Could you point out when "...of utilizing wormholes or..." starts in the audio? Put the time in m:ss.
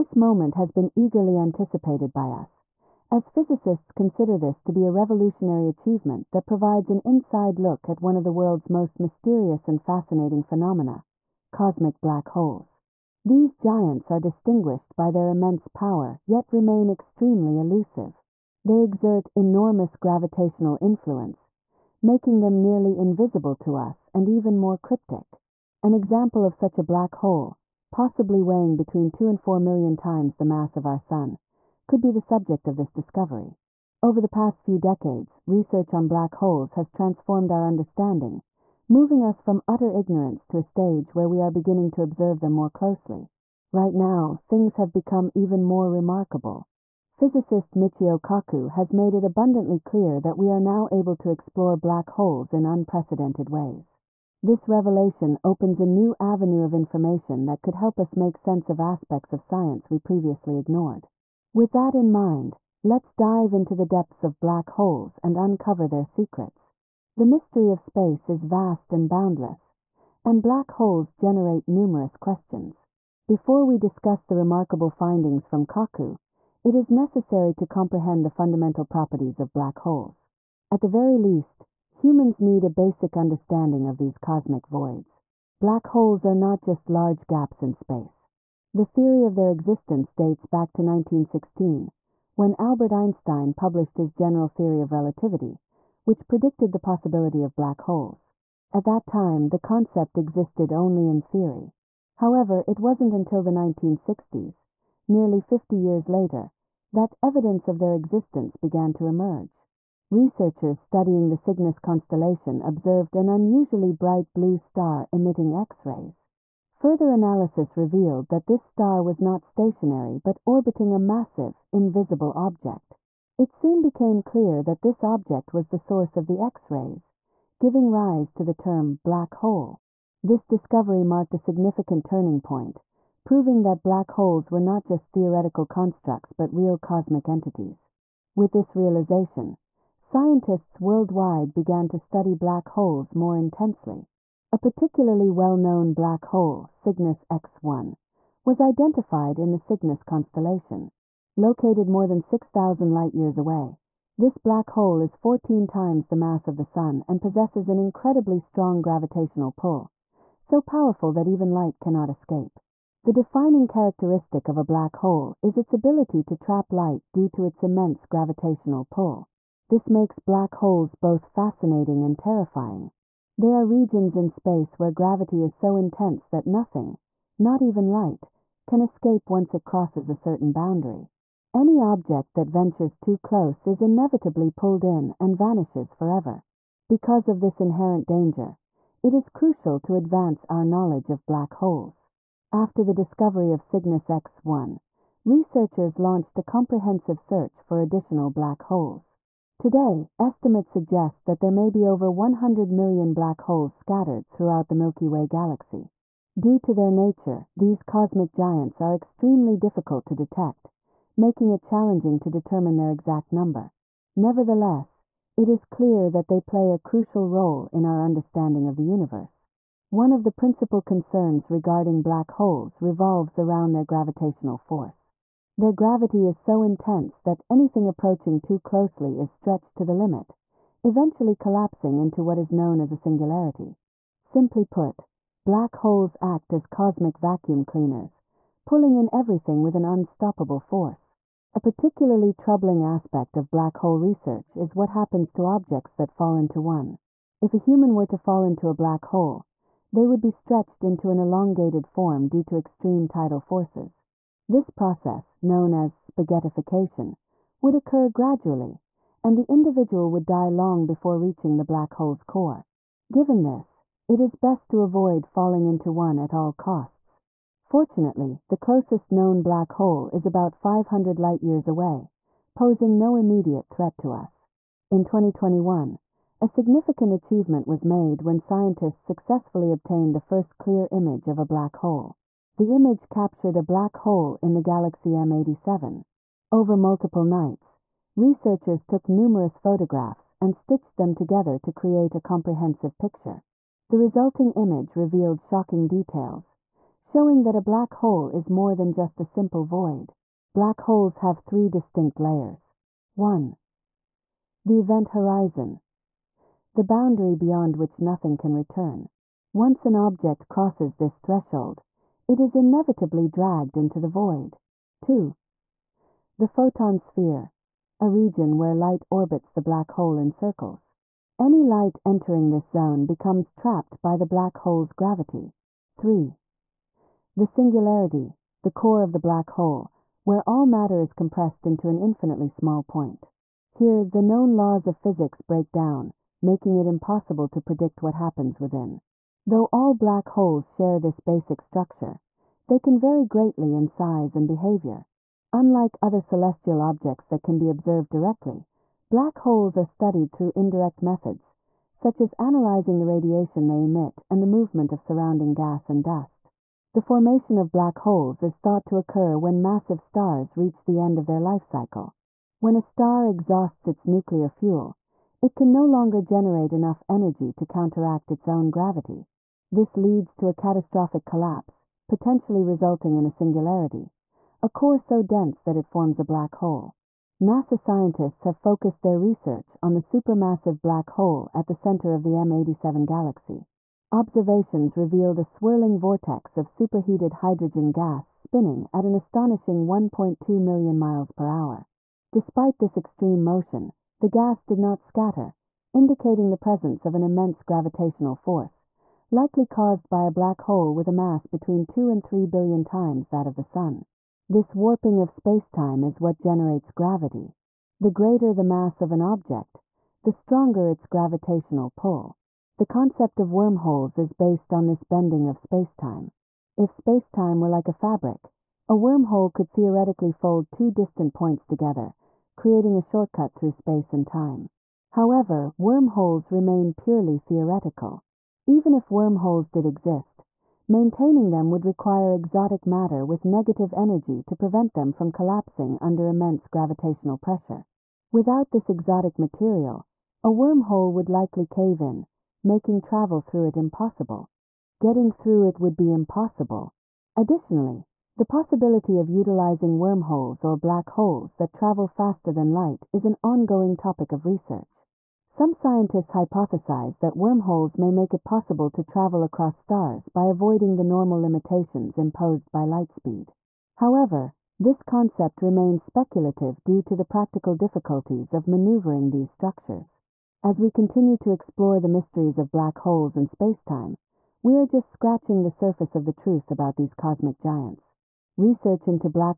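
7:29.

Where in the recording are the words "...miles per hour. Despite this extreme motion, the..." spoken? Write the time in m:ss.
6:30.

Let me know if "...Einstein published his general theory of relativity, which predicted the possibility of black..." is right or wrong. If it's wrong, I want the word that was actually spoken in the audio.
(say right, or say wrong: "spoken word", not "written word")
right.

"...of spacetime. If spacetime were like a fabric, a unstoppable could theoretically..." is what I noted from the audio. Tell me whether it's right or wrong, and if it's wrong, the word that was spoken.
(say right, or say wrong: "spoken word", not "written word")
wrong: "wormhole", not "unstoppable".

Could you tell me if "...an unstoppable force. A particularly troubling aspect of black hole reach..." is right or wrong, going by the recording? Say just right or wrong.
wrong.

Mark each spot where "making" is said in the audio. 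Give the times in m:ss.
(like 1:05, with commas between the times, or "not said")
0:21, 3:31, 5:36, 7:22.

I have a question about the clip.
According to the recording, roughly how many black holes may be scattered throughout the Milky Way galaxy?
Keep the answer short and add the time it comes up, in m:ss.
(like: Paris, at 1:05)
over 100 million, at 3:21.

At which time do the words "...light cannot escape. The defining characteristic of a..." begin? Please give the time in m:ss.
2:41.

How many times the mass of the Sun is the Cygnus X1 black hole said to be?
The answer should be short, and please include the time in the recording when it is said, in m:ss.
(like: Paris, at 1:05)
14, at 2:35.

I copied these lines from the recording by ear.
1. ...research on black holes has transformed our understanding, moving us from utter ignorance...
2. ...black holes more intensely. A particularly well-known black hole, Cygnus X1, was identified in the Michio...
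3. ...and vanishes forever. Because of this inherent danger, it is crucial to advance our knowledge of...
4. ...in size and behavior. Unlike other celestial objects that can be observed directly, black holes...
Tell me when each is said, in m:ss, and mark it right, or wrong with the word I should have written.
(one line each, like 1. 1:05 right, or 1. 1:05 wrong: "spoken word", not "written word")
1. 0:35 right
2. 2:22 wrong: "Cygnus", not "Michio"
3. 3:05 right
4. 5:43 right.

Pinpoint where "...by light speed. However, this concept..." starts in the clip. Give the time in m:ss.
7:42.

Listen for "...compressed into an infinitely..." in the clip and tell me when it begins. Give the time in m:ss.
5:31.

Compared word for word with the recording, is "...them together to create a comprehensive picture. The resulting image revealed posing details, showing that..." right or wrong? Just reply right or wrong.
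wrong.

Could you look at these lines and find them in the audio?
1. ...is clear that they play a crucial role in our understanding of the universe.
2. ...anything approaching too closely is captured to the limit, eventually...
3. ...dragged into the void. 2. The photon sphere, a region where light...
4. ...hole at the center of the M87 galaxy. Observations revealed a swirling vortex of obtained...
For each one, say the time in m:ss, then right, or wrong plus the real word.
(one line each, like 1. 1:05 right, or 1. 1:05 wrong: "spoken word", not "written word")
1. 3:35 right
2. 3:47 wrong: "stretched", not "captured"
3. 5:13 right
4. 6:21 wrong: "superheated", not "obtained".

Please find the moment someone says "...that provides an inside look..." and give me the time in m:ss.
0:06.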